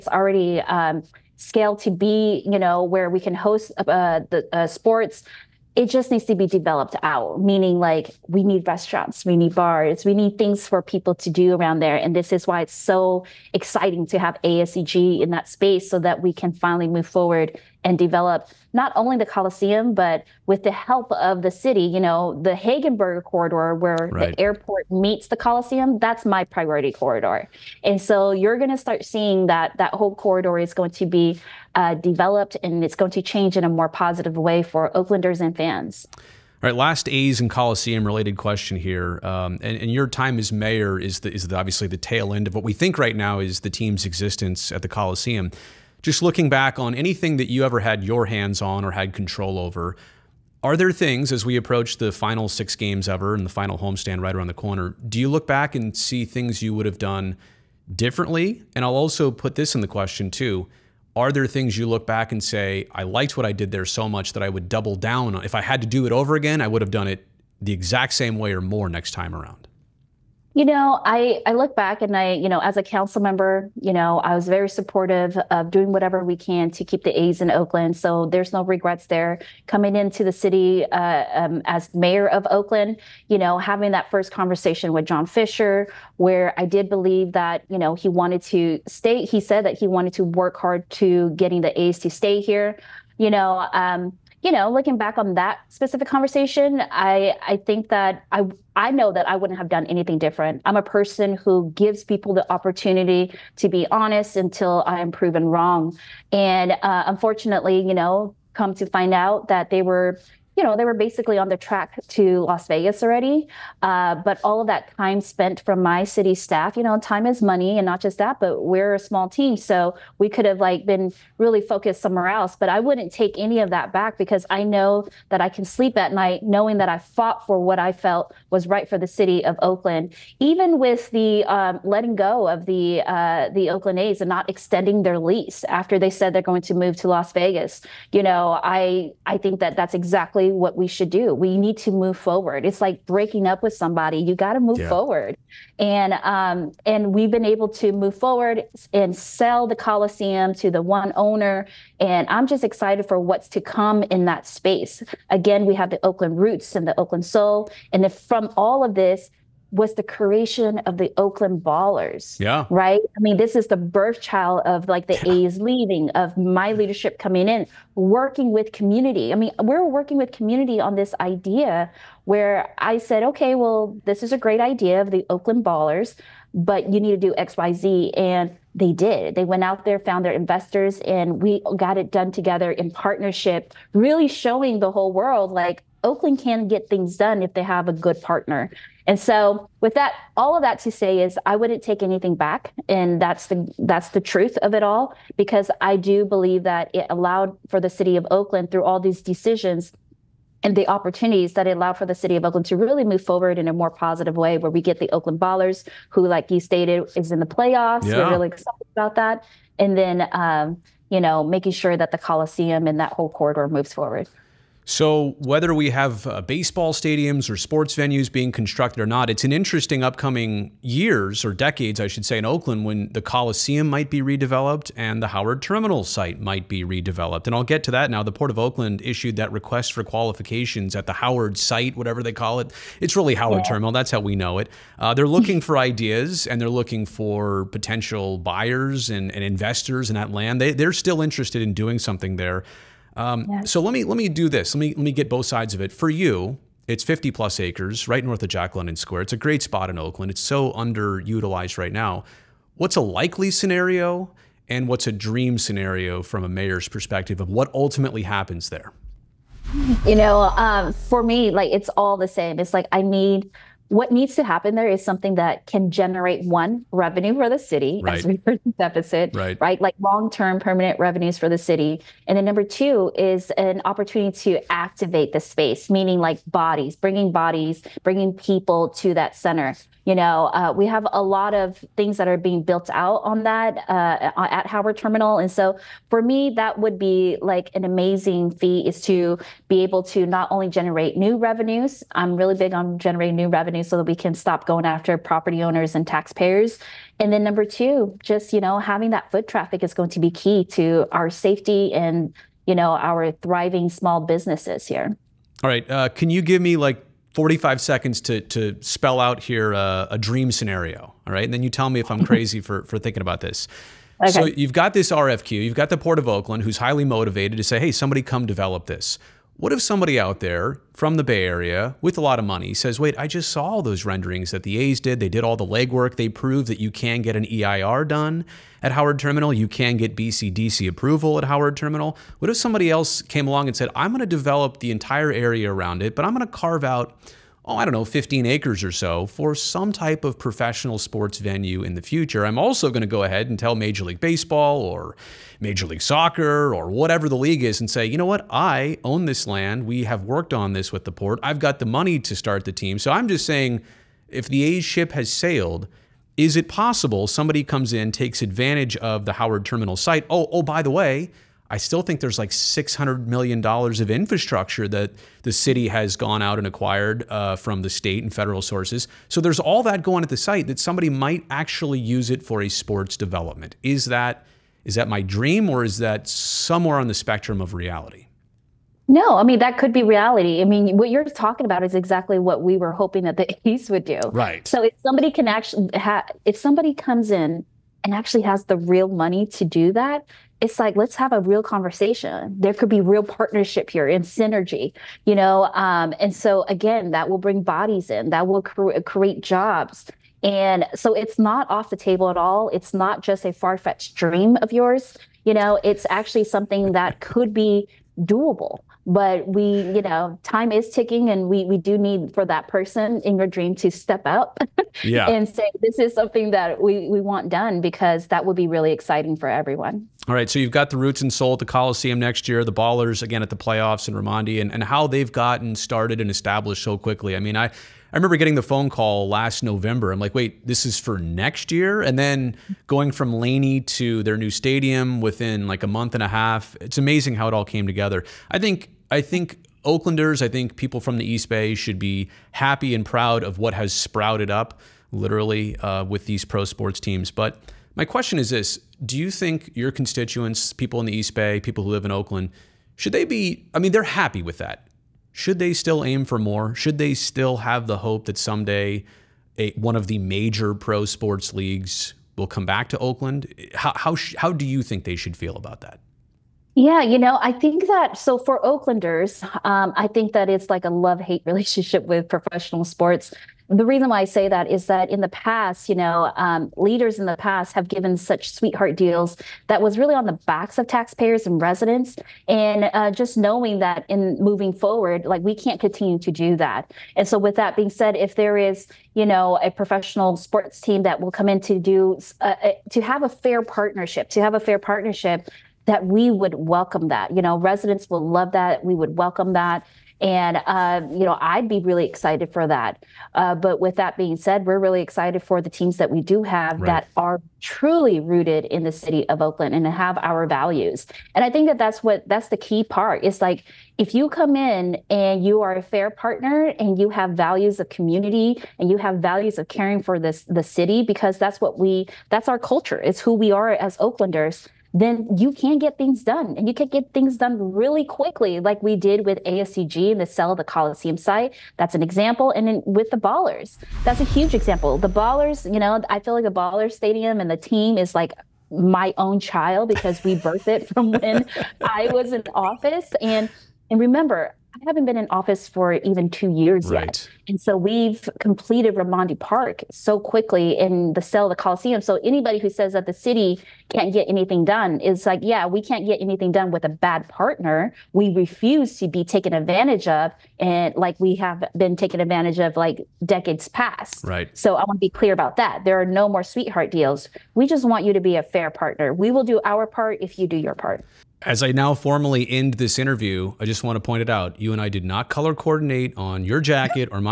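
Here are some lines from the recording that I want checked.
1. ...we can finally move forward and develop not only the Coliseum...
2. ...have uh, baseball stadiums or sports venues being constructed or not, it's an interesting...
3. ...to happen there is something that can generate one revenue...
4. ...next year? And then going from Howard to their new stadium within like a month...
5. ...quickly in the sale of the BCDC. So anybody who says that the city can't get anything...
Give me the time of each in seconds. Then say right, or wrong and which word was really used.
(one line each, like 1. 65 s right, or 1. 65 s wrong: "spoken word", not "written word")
1. 16 s right
2. 215 s right
3. 264 s right
4. 431 s wrong: "Laney", not "Howard"
5. 550 s wrong: "Coliseum", not "BCDC".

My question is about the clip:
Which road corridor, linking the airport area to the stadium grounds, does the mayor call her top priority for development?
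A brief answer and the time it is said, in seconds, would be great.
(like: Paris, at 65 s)
Hegenberger corridor, at 22 s.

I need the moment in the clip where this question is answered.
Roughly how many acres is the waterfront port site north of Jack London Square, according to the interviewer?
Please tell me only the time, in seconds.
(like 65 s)
247 s.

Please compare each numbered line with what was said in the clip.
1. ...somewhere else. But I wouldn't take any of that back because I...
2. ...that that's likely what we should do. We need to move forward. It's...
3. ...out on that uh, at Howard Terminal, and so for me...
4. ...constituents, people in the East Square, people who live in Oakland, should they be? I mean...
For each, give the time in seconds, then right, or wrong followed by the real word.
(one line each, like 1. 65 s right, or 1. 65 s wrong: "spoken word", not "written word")
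1. 122 s right
2. 139 s wrong: "exactly", not "likely"
3. 282 s right
4. 449 s wrong: "Bay", not "Square".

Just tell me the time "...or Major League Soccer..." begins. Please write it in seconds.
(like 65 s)
344 s.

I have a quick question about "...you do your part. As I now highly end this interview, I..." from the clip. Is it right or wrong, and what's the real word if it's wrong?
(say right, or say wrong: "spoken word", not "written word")
wrong: "formally", not "highly".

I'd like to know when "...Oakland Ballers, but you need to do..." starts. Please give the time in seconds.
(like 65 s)
175 s.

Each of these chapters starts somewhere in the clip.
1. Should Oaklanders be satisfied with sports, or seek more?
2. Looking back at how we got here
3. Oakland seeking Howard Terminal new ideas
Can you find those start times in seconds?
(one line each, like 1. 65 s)
1. 421 s
2. 50 s
3. 225 s.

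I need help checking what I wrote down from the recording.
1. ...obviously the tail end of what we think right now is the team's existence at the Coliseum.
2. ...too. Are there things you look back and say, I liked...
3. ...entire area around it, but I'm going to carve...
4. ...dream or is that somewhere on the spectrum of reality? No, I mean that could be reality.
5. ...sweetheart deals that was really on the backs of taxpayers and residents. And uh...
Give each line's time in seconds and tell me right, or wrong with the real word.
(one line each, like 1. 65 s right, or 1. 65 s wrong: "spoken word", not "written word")
1. 41 s right
2. 60 s right
3. 334 s right
4. 375 s right
5. 478 s right.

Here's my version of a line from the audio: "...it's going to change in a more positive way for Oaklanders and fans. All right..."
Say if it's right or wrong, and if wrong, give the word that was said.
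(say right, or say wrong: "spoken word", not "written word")
right.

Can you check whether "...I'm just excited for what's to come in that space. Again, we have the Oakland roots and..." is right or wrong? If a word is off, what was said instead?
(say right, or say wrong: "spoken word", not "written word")
right.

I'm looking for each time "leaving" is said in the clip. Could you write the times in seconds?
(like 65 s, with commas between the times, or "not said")
165 s.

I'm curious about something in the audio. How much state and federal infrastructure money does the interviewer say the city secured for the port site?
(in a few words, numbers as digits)
$600 million.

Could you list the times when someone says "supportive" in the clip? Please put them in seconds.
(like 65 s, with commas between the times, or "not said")
74 s.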